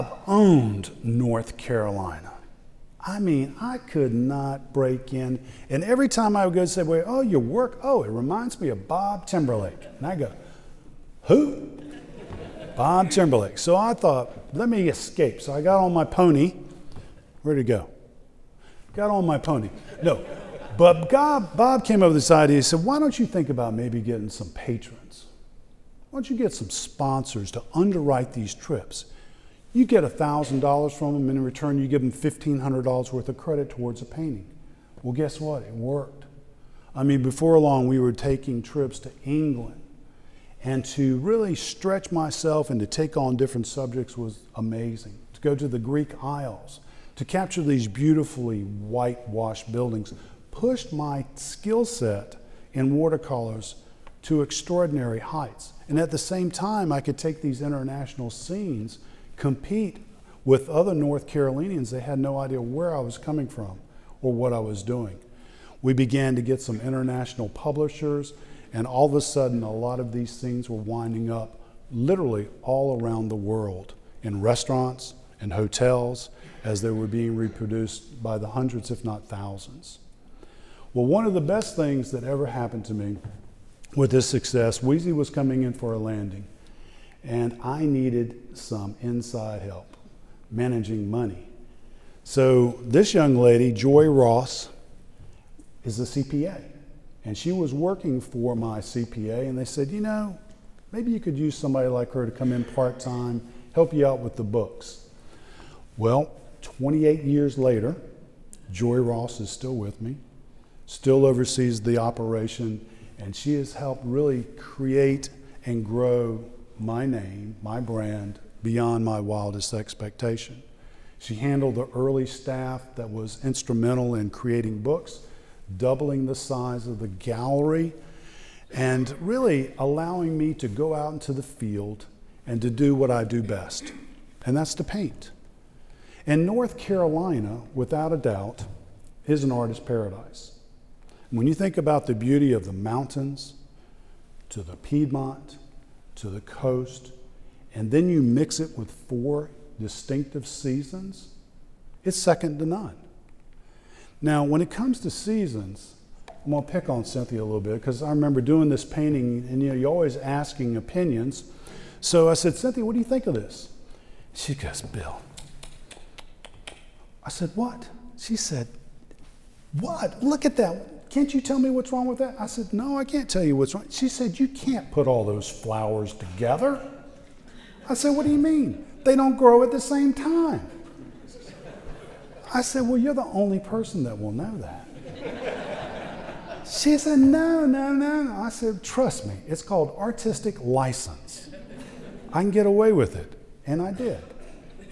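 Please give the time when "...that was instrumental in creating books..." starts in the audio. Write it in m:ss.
2:02.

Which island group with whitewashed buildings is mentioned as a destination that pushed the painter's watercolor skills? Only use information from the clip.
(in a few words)
Greek Isles.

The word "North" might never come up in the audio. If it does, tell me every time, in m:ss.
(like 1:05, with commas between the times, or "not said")
0:01, 1:00, 2:16.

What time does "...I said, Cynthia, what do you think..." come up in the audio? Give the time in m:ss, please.
2:42.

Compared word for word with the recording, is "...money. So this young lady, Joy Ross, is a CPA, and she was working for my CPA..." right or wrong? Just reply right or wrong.
right.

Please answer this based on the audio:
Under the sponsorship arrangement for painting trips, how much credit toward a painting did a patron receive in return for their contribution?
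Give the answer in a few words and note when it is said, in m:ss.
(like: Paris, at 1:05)
$1,500, at 0:32.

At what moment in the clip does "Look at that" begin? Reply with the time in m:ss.
2:50.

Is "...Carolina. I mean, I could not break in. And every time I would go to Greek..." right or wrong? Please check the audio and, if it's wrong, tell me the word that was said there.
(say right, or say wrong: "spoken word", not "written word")
wrong: "Subway", not "Greek".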